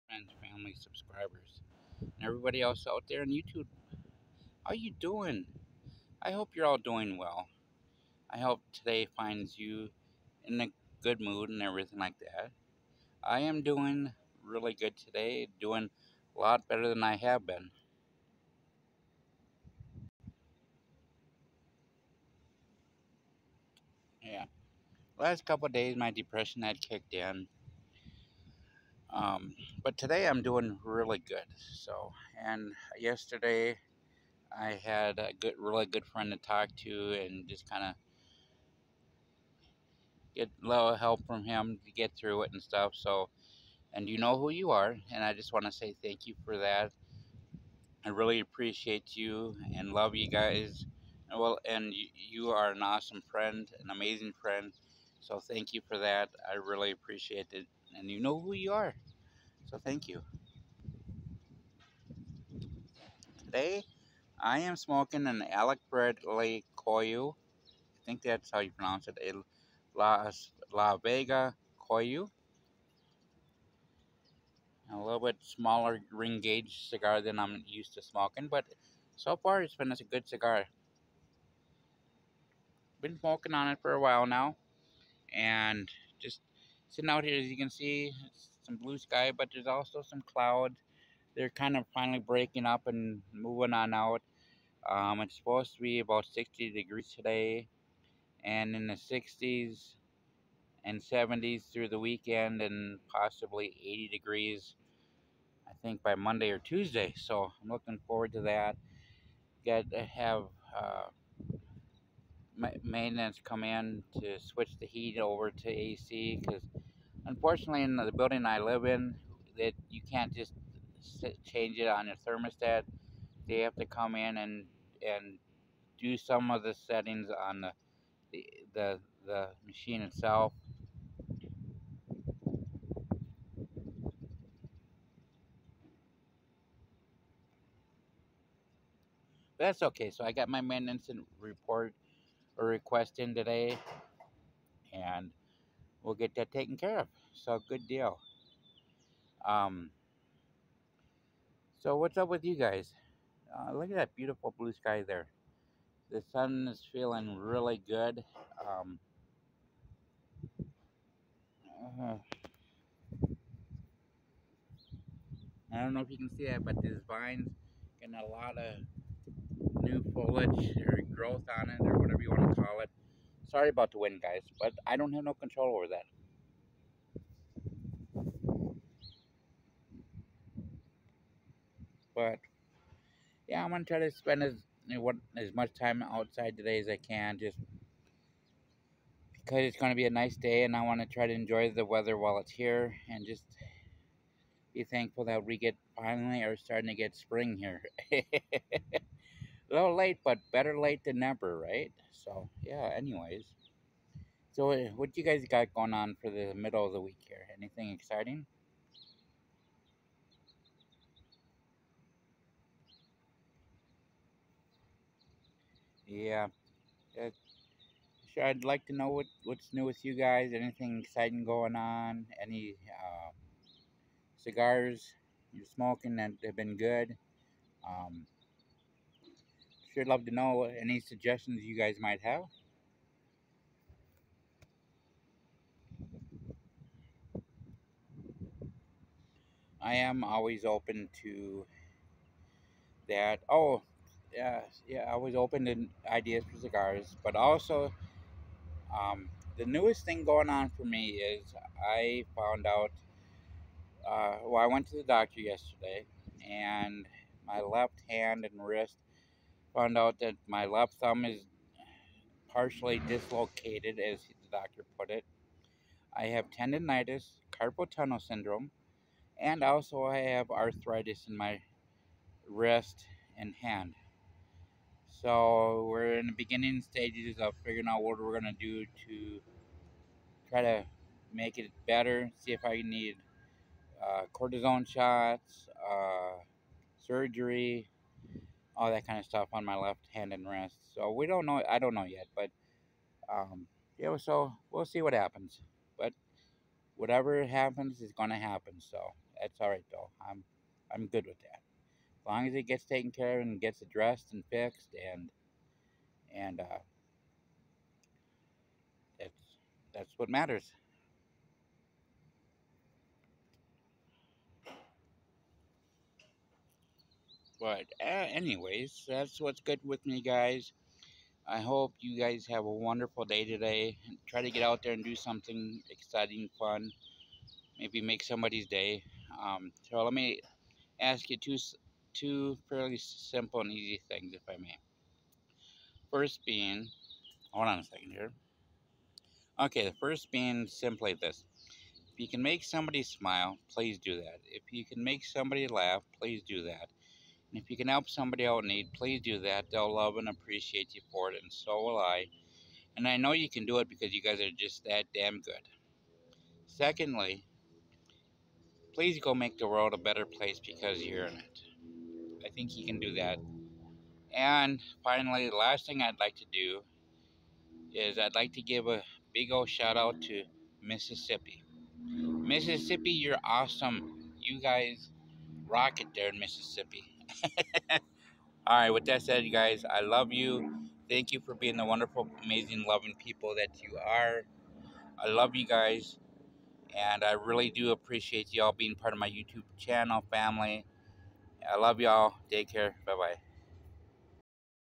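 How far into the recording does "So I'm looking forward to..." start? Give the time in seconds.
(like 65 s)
107 s.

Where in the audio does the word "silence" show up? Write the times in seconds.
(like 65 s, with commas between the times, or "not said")
not said.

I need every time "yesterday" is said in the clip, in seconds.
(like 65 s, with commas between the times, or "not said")
32 s, 255 s.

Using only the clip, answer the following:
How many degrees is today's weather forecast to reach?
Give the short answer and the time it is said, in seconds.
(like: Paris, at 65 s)
60, at 95 s.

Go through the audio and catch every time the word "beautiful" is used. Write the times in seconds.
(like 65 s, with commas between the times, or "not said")
154 s.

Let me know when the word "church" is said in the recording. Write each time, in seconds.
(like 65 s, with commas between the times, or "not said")
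not said.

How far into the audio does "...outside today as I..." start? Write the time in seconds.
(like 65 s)
186 s.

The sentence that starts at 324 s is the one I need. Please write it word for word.
Try to get out there and do something exciting, fun.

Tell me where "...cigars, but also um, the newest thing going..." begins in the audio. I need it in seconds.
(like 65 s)
246 s.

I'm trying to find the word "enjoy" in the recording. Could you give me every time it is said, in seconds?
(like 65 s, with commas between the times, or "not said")
191 s.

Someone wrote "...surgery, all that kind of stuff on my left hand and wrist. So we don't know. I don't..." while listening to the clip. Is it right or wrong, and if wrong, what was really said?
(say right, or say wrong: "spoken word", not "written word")
right.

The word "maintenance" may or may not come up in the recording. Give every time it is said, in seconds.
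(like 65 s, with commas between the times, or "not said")
112 s, 140 s.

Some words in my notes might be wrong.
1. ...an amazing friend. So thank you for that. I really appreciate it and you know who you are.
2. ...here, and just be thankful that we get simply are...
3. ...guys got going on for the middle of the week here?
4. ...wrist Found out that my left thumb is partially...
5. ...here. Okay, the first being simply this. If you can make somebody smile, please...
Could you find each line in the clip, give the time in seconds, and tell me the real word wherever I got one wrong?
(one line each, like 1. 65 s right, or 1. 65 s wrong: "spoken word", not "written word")
1. 53 s right
2. 192 s wrong: "finally", not "simply"
3. 205 s right
4. 258 s right
5. 338 s right.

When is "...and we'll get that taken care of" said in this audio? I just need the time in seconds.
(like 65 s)
144 s.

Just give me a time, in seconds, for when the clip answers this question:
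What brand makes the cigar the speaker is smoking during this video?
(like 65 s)
65 s.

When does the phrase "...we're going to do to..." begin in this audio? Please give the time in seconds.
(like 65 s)
278 s.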